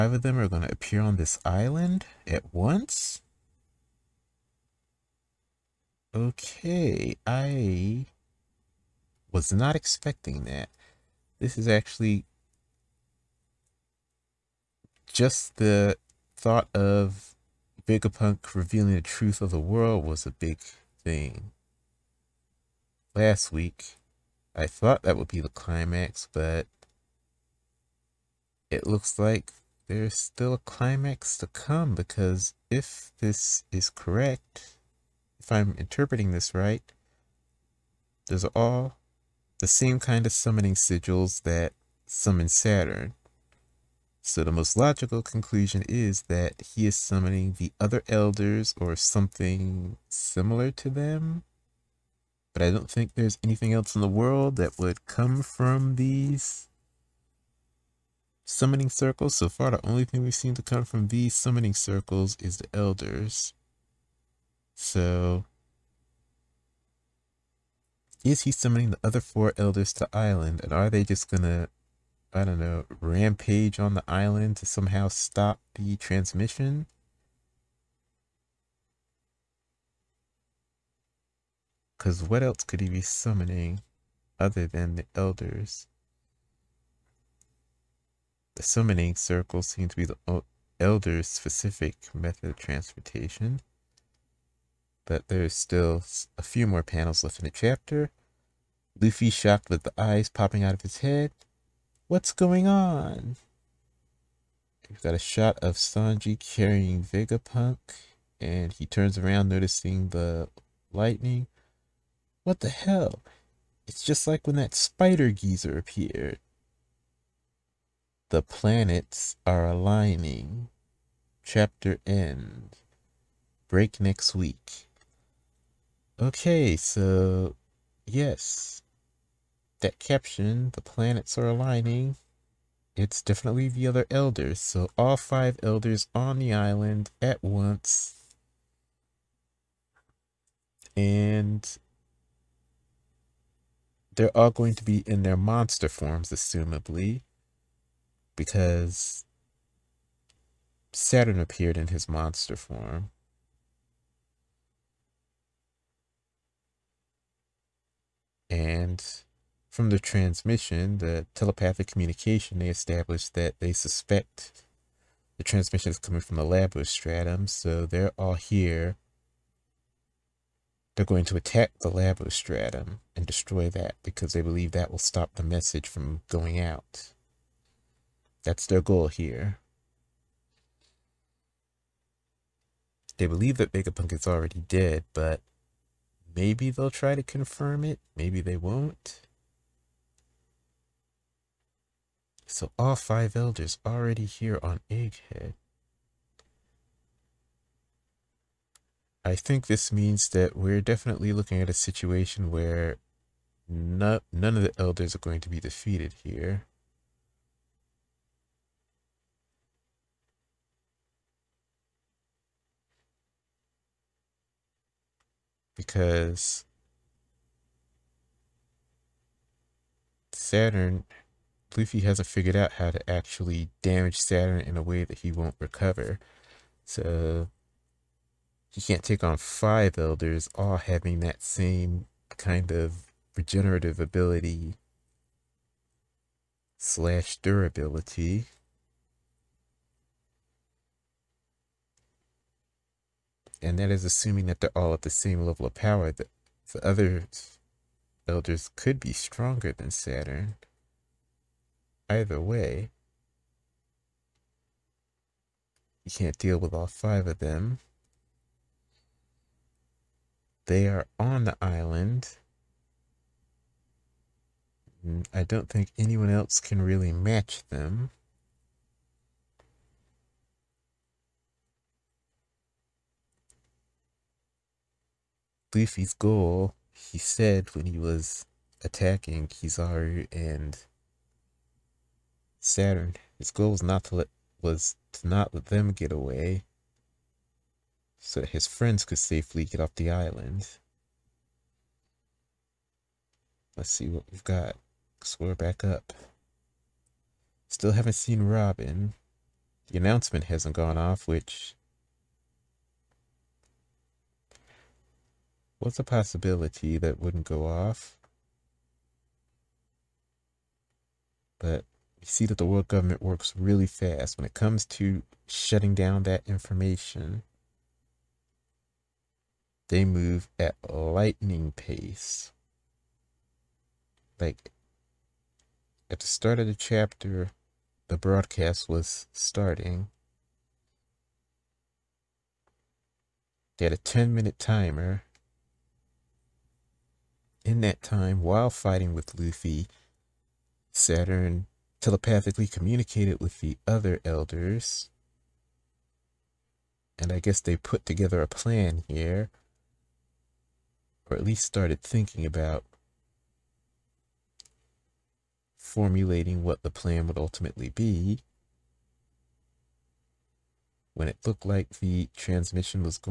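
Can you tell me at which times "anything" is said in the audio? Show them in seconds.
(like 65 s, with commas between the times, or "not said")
53 s.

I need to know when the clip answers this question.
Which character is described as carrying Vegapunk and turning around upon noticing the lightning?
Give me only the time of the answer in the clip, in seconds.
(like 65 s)
105 s.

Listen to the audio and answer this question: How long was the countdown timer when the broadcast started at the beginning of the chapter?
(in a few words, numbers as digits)
10 minutes.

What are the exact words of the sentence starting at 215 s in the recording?
Because Saturn, Luffy hasn't figured out how to actually damage Saturn in a way that he won't recover.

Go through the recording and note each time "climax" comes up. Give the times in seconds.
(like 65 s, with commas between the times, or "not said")
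25 s, 30 s.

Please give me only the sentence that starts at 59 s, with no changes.
So far, the only thing we've seen to come from these summoning circles is the elders.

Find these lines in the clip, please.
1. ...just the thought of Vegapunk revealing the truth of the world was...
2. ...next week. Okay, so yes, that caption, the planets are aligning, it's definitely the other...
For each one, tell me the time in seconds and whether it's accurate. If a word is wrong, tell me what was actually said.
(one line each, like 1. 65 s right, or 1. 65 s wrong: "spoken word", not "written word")
1. 15 s right
2. 124 s right.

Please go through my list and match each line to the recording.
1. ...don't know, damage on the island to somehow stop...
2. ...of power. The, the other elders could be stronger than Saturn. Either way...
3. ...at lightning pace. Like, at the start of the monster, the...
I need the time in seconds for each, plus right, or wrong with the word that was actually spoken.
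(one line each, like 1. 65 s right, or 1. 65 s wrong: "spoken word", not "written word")
1. 72 s wrong: "rampage", not "damage"
2. 245 s right
3. 320 s wrong: "chapter", not "monster".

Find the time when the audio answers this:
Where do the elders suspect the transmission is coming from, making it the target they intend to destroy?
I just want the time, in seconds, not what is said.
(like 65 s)
166 s.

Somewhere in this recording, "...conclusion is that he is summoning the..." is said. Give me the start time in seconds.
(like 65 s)
45 s.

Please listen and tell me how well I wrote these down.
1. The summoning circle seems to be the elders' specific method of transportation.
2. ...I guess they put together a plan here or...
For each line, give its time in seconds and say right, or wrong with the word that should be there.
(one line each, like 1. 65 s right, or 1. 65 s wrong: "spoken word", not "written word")
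1. 88 s right
2. 347 s right.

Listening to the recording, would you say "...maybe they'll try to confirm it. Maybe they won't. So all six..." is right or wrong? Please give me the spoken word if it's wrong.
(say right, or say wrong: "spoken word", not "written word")
wrong: "five", not "six".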